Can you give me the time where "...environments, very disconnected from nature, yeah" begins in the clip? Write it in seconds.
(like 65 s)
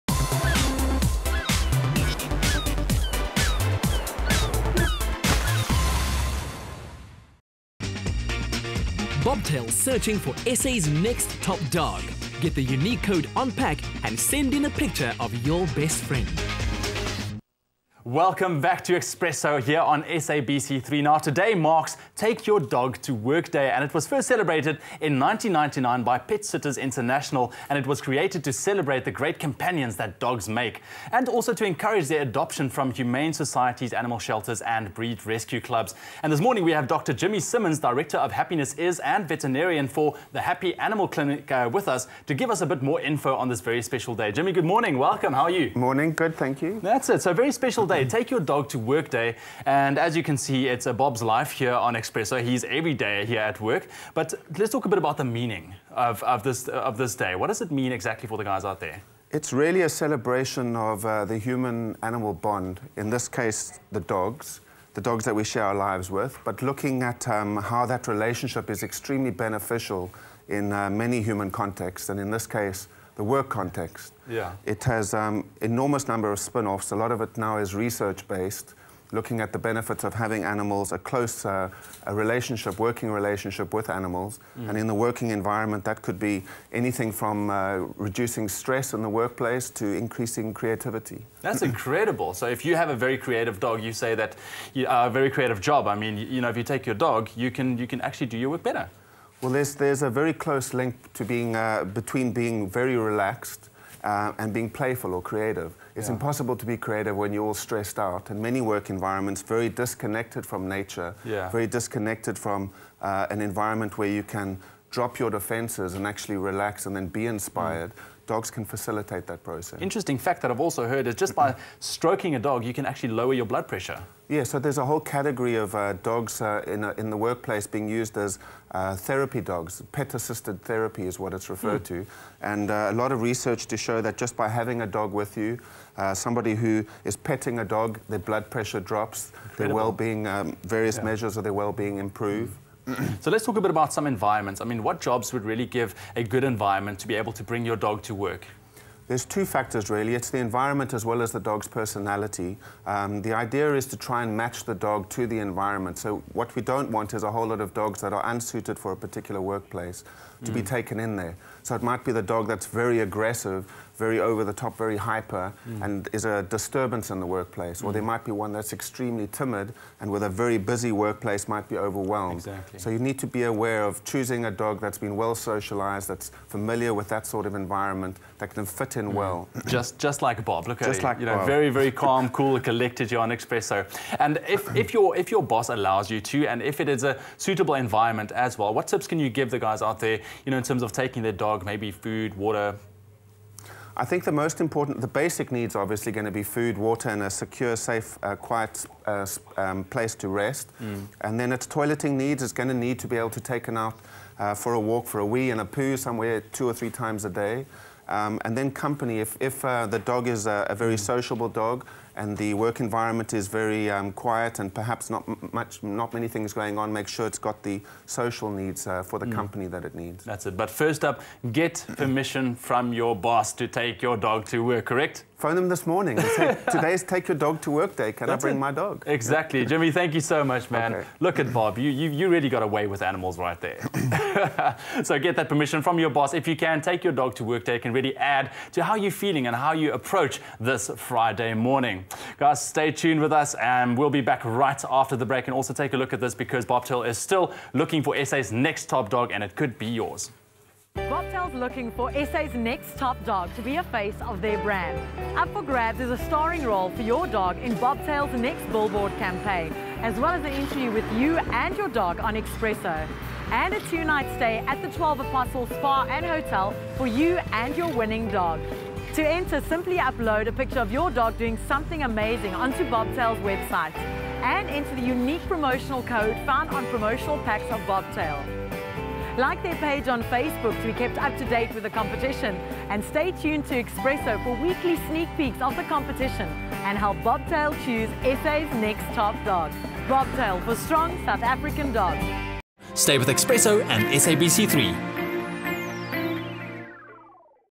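108 s.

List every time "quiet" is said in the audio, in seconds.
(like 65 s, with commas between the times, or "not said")
198 s, 214 s.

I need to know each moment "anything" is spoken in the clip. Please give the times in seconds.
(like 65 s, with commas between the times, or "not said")
86 s.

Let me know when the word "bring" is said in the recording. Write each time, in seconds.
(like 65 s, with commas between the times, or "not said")
147 s, 228 s.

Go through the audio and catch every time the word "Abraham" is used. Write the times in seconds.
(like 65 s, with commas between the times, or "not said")
not said.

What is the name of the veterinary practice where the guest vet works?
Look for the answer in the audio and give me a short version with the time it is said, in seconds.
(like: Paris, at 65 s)
Happy Animal Clinic, at 40 s.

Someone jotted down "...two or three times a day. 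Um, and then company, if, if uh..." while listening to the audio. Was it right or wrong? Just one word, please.
right.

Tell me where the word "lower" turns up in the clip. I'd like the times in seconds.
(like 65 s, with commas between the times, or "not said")
123 s.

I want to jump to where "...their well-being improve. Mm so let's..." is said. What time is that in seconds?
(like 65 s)
141 s.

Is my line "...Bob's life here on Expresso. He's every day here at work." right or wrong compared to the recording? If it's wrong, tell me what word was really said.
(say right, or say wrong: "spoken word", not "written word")
right.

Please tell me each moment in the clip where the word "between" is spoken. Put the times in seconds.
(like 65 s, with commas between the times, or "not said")
101 s.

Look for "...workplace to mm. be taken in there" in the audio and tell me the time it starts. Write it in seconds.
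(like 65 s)
159 s.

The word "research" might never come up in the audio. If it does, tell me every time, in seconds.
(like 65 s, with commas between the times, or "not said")
77 s, 133 s.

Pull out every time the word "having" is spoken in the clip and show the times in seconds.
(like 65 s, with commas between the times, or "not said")
80 s, 134 s.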